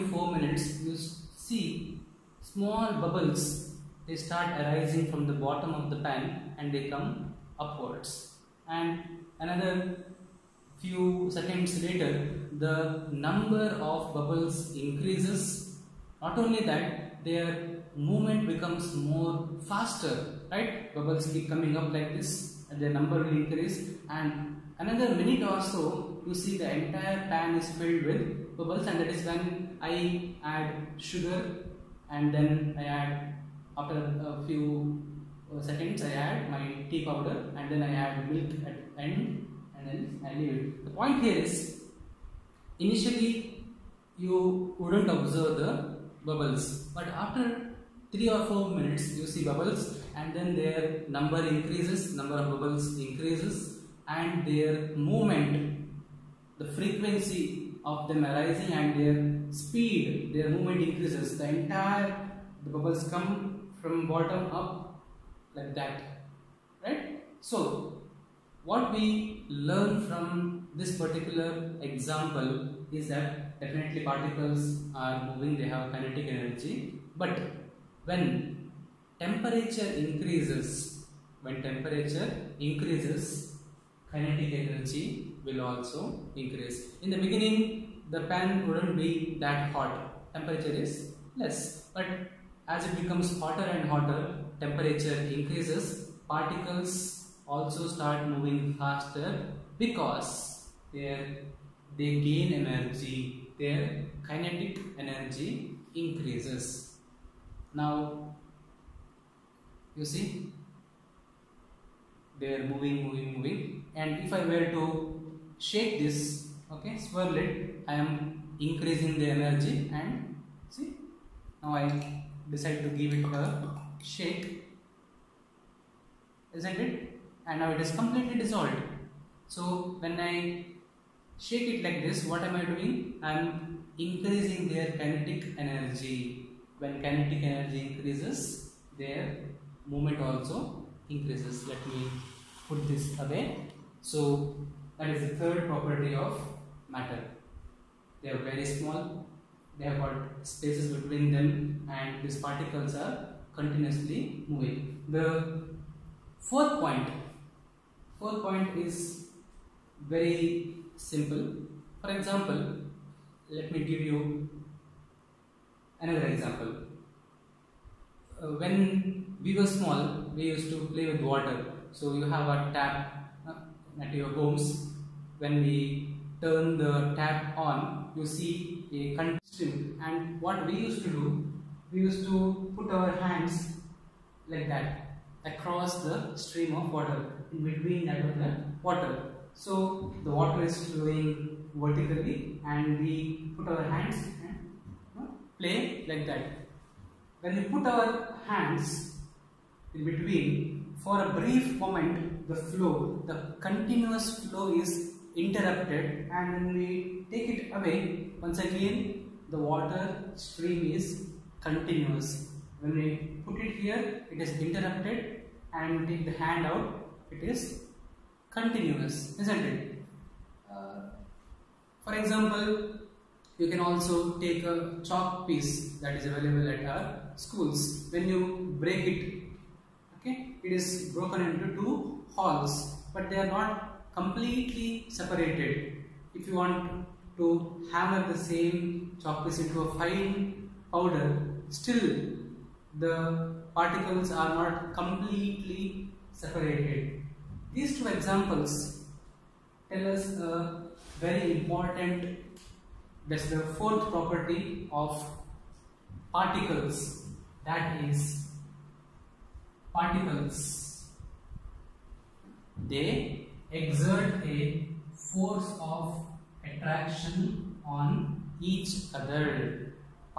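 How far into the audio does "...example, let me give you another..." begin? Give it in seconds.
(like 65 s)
162 s.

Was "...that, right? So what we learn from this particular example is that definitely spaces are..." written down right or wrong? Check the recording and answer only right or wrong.
wrong.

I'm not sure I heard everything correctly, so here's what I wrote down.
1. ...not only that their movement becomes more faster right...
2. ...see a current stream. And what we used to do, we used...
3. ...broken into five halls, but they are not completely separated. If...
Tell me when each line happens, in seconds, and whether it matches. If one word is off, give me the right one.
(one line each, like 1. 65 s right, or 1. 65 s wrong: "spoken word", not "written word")
1. 16 s right
2. 178 s right
3. 231 s wrong: "two", not "five".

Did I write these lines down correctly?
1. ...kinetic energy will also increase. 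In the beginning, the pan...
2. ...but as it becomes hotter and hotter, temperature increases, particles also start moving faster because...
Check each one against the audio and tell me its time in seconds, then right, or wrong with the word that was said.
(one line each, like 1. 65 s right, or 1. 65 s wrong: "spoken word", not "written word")
1. 84 s right
2. 91 s right.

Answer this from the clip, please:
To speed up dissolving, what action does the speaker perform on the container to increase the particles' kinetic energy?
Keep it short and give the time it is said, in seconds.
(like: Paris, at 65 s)
shake it, at 123 s.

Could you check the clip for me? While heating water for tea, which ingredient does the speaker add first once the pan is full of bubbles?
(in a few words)
sugar.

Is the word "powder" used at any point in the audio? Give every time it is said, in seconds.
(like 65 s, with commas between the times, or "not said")
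37 s, 240 s.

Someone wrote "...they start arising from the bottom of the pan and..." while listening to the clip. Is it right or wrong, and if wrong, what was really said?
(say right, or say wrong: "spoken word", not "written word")
right.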